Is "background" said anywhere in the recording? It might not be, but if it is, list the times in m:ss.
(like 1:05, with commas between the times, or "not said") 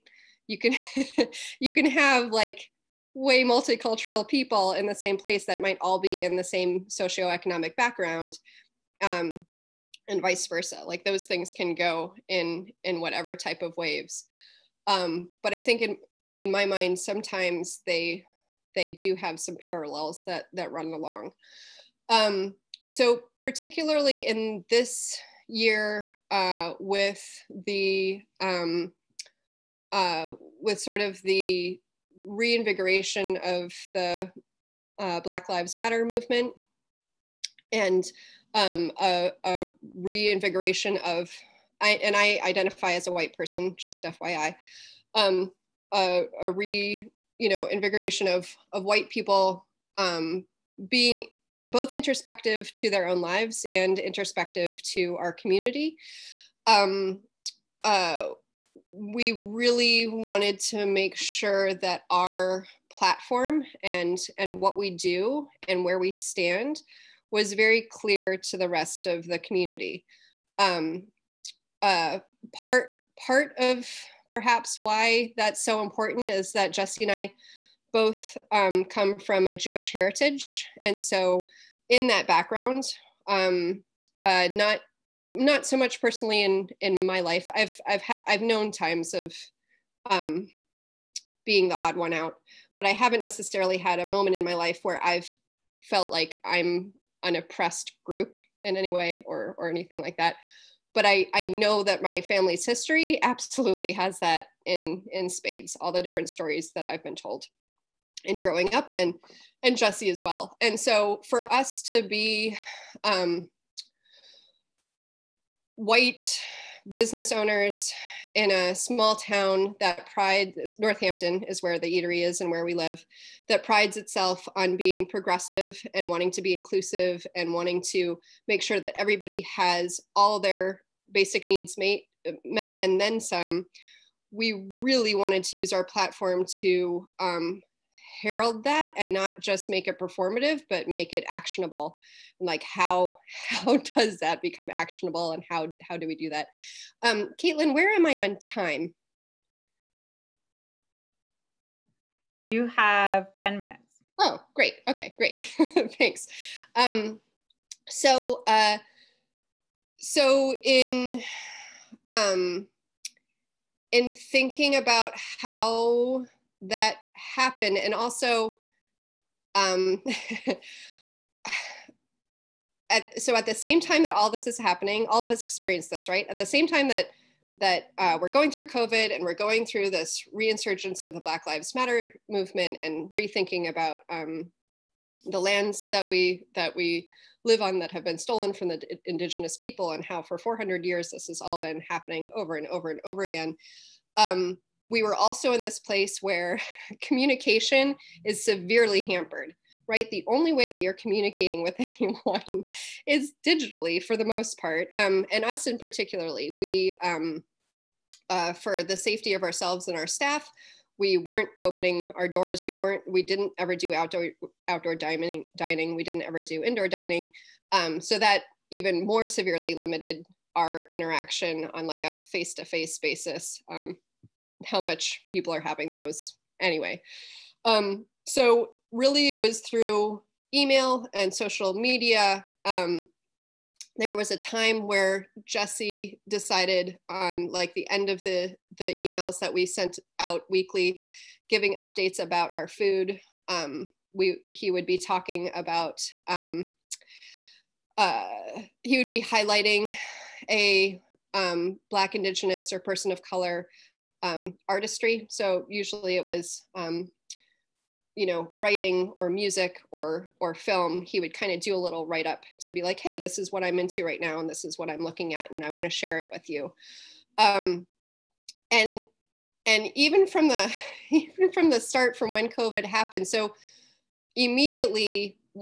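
0:07, 1:22.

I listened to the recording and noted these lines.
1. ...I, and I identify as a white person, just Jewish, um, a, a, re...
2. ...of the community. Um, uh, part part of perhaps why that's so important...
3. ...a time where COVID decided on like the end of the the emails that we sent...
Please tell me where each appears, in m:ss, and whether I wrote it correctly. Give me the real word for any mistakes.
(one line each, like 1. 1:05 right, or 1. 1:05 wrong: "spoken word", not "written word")
1. 0:41 wrong: "FYI", not "Jewish"
2. 1:09 right
3. 3:54 wrong: "Jesse", not "COVID".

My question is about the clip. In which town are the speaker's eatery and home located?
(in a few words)
Northampton.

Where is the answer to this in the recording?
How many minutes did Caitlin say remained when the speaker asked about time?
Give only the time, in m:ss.
2:33.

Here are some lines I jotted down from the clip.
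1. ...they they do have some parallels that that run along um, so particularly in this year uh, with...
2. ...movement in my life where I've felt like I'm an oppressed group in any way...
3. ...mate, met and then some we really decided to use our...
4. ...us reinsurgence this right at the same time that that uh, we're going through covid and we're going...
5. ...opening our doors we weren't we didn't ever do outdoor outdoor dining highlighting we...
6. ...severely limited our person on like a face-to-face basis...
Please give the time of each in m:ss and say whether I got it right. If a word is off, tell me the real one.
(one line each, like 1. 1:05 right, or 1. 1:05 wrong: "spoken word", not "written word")
1. 0:17 right
2. 1:34 wrong: "moment", not "movement"
3. 2:11 wrong: "wanted", not "decided"
4. 2:55 wrong: "experience", not "reinsurgence"
5. 3:31 wrong: "dining", not "highlighting"
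6. 3:39 wrong: "interaction", not "person".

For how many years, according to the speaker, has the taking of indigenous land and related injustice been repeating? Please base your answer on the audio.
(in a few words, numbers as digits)
400.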